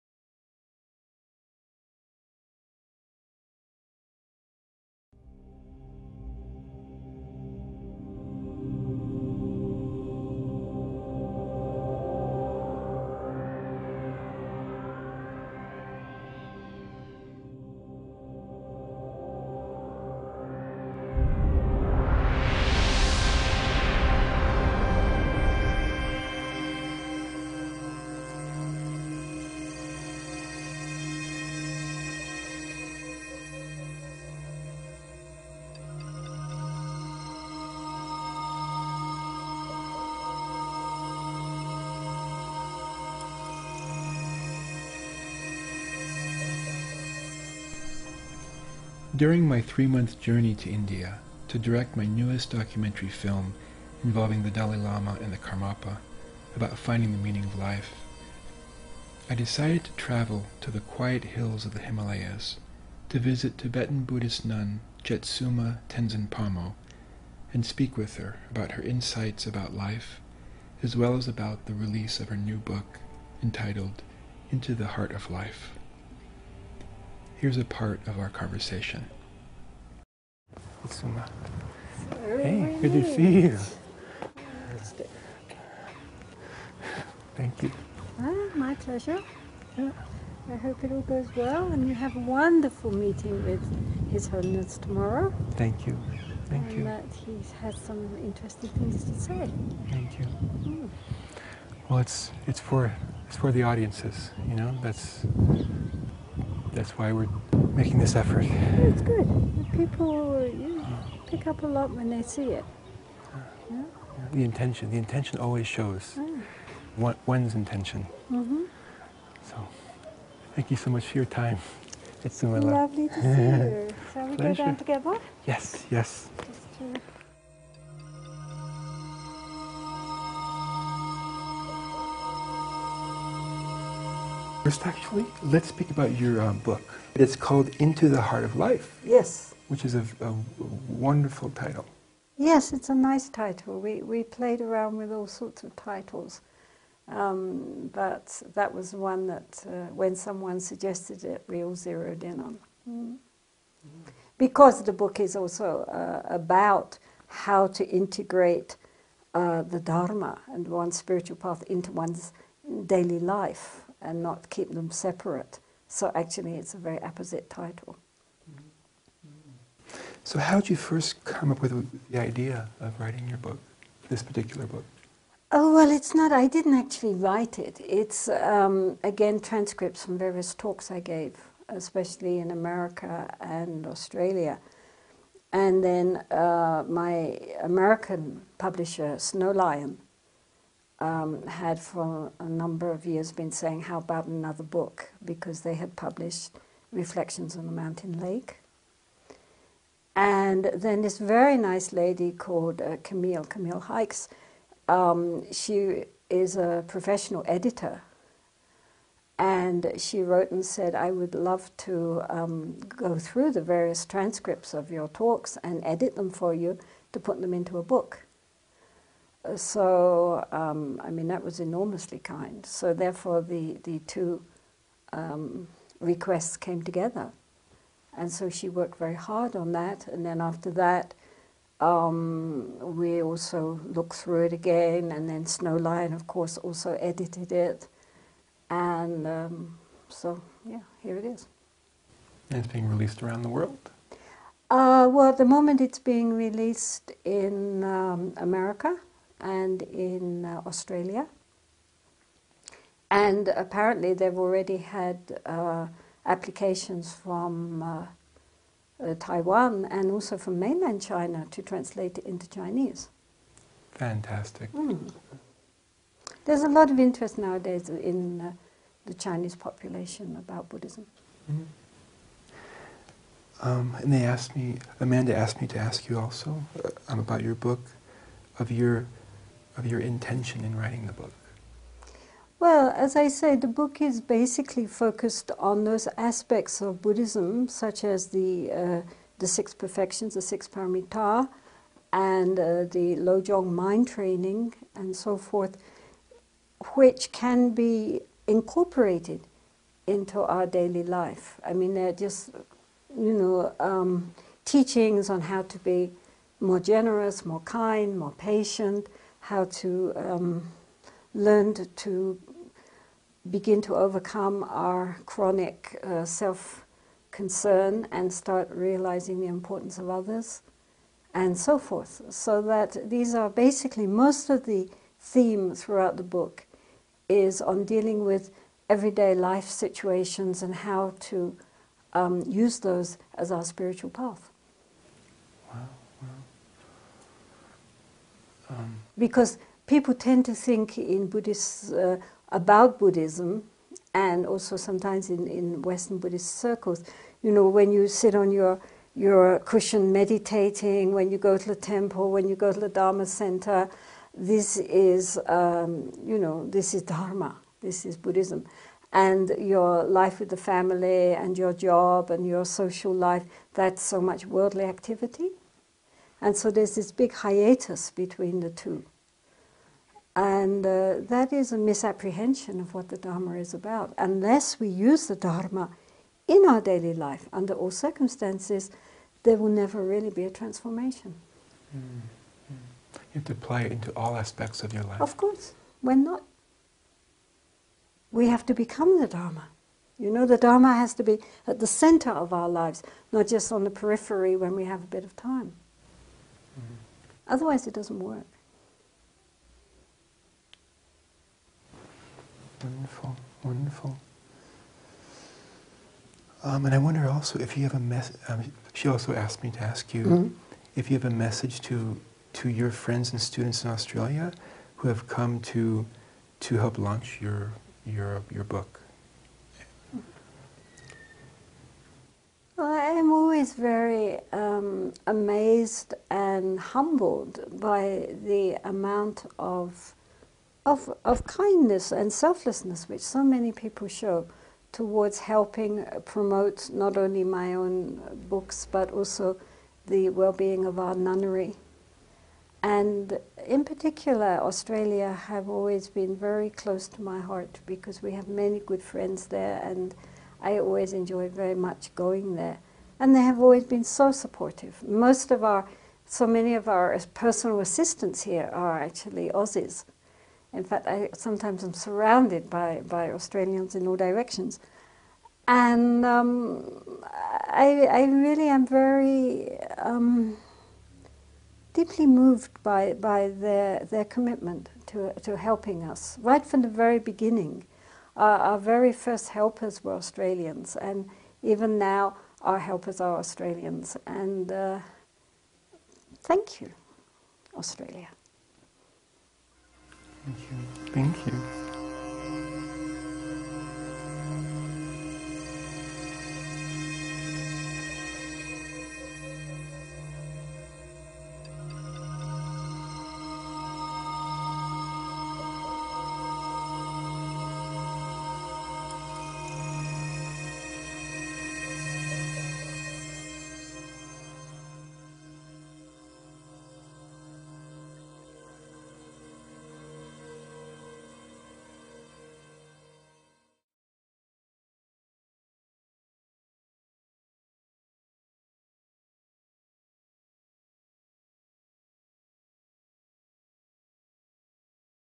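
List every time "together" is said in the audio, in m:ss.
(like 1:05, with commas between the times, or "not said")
2:04, 3:46.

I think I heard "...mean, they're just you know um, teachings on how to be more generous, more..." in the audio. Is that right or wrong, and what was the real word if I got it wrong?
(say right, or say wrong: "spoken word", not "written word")
right.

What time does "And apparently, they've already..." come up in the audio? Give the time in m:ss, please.
4:13.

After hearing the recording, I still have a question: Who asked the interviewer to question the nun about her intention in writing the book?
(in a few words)
Amanda.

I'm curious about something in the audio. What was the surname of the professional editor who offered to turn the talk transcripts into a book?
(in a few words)
Hikes.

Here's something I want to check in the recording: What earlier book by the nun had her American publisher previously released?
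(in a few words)
Reflections on a Mountain Lake.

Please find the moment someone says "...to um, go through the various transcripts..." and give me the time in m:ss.
3:31.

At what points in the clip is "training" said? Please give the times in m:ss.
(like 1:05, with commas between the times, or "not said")
4:54.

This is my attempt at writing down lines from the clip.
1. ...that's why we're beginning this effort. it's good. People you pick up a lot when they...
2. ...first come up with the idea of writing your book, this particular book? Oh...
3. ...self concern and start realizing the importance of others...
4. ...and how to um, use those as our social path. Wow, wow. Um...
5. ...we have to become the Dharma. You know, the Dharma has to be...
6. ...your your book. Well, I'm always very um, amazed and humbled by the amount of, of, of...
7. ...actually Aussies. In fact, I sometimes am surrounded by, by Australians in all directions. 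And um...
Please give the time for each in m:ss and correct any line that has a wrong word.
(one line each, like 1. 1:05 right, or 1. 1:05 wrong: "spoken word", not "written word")
1. 1:46 wrong: "making", not "beginning"
2. 2:50 right
3. 5:16 right
4. 5:30 wrong: "spiritual", not "social"
5. 6:28 right
6. 6:58 right
7. 7:39 right.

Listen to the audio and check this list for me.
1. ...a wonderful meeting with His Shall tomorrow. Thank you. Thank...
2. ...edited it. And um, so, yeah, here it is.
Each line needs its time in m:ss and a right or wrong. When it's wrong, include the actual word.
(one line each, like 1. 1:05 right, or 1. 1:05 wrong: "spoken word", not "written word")
1. 1:32 wrong: "Holiness", not "Shall"
2. 3:57 right.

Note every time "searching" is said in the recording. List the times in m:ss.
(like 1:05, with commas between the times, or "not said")
not said.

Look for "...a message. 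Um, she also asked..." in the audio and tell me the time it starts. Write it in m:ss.
6:47.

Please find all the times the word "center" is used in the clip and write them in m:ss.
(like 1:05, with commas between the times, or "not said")
5:53, 6:31.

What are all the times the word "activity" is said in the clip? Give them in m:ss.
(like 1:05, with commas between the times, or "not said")
6:04.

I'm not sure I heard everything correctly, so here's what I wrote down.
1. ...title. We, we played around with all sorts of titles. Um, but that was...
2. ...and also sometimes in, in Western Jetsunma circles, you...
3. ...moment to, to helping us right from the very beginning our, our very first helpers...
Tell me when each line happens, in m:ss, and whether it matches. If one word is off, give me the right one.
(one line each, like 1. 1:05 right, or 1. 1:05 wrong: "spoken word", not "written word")
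1. 2:23 right
2. 5:44 wrong: "Buddhist", not "Jetsunma"
3. 7:54 wrong: "commitment", not "moment".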